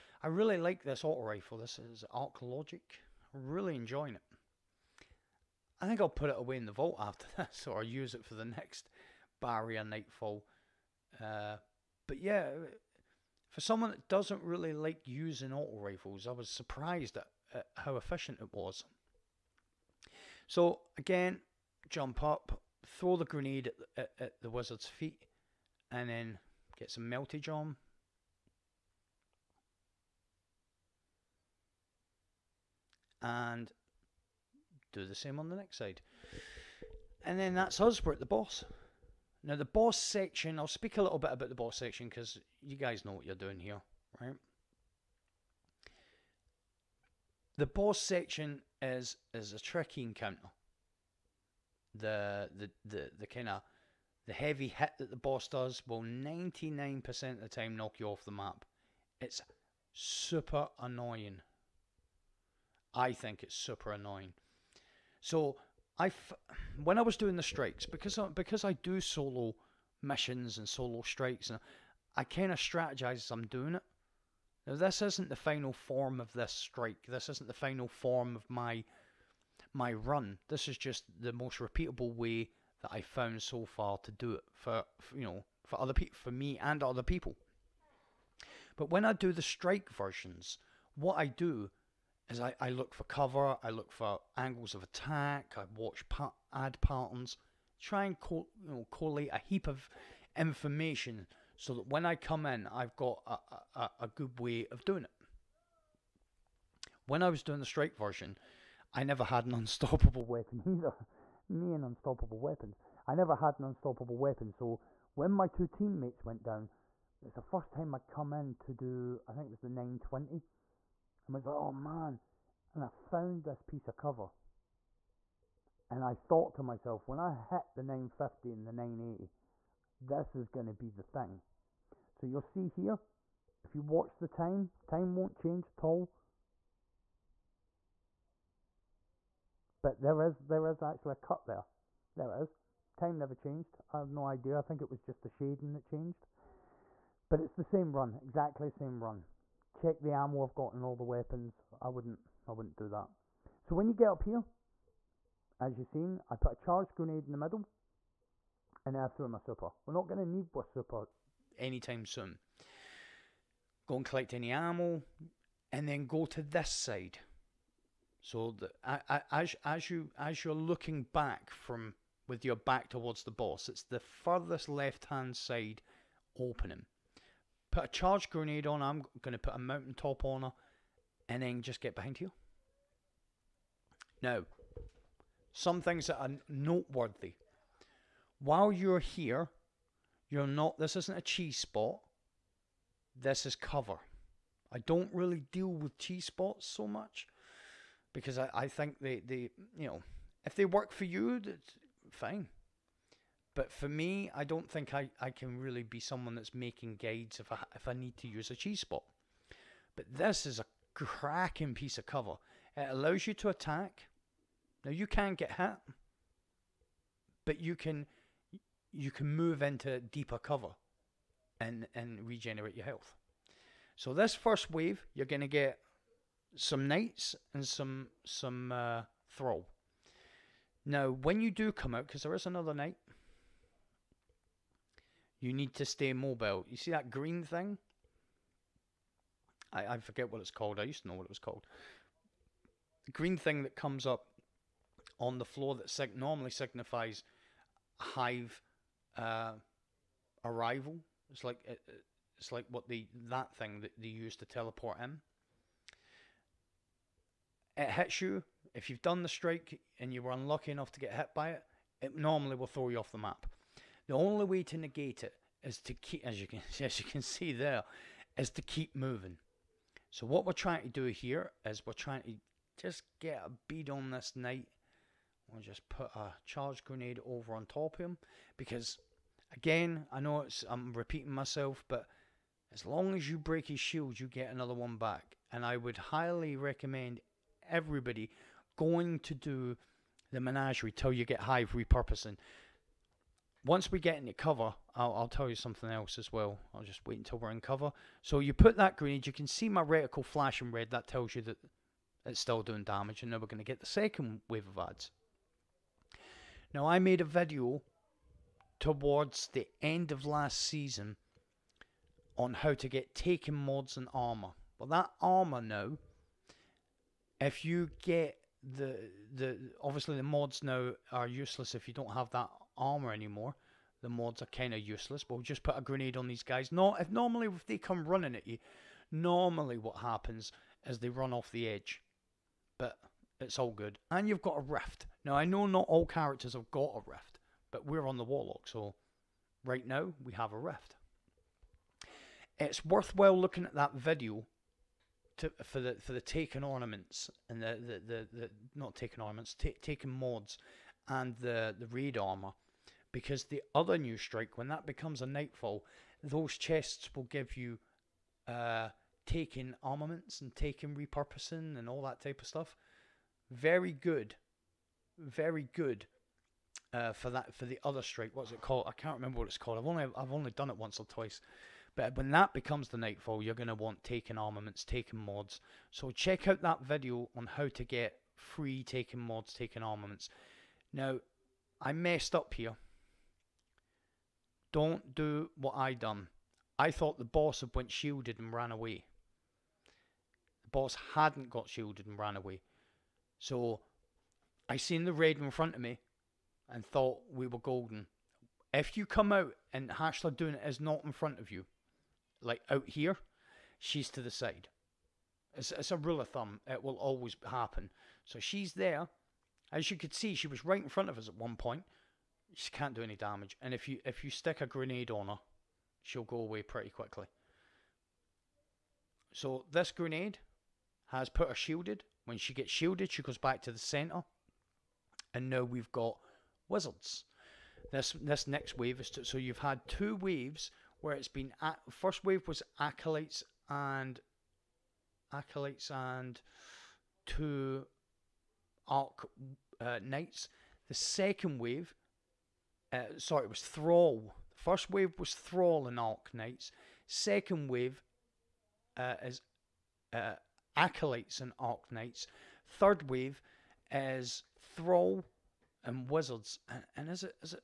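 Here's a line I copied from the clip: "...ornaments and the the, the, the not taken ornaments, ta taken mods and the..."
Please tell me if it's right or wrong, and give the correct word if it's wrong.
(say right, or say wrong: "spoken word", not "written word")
right.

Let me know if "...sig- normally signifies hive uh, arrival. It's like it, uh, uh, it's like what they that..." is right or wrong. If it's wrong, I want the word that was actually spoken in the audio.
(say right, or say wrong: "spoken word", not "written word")
right.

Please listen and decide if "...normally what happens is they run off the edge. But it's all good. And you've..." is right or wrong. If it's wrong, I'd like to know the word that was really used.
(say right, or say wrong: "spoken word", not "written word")
right.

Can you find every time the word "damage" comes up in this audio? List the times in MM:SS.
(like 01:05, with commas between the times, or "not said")
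05:02, 06:53.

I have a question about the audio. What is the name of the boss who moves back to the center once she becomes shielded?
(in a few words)
Hashladun.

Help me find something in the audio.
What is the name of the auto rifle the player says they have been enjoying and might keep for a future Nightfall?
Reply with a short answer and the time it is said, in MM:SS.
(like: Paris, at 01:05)
Arc Logic, at 00:02.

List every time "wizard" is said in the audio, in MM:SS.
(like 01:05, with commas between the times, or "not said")
00:24, 07:06, 07:36.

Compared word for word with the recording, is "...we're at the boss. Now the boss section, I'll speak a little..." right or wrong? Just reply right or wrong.
right.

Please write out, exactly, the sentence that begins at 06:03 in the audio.
Very good, very good uh, for that for the other strike.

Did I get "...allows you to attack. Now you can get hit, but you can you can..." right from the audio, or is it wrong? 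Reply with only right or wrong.
right.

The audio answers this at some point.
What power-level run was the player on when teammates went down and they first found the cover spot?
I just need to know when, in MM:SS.
01:59.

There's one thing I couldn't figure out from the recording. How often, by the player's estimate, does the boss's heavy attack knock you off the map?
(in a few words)
99%.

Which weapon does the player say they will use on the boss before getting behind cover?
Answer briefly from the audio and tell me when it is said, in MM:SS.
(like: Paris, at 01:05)
Mountaintop, at 02:59.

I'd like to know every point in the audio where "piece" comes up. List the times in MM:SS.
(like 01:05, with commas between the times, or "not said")
02:03, 03:31.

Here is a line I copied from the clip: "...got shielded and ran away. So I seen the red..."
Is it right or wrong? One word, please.
right.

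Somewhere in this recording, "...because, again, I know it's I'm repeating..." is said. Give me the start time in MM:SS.
04:38.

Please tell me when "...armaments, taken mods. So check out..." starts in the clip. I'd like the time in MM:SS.
06:14.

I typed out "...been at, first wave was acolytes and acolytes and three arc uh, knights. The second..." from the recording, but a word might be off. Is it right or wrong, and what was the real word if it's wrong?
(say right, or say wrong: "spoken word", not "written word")
wrong: "two", not "three".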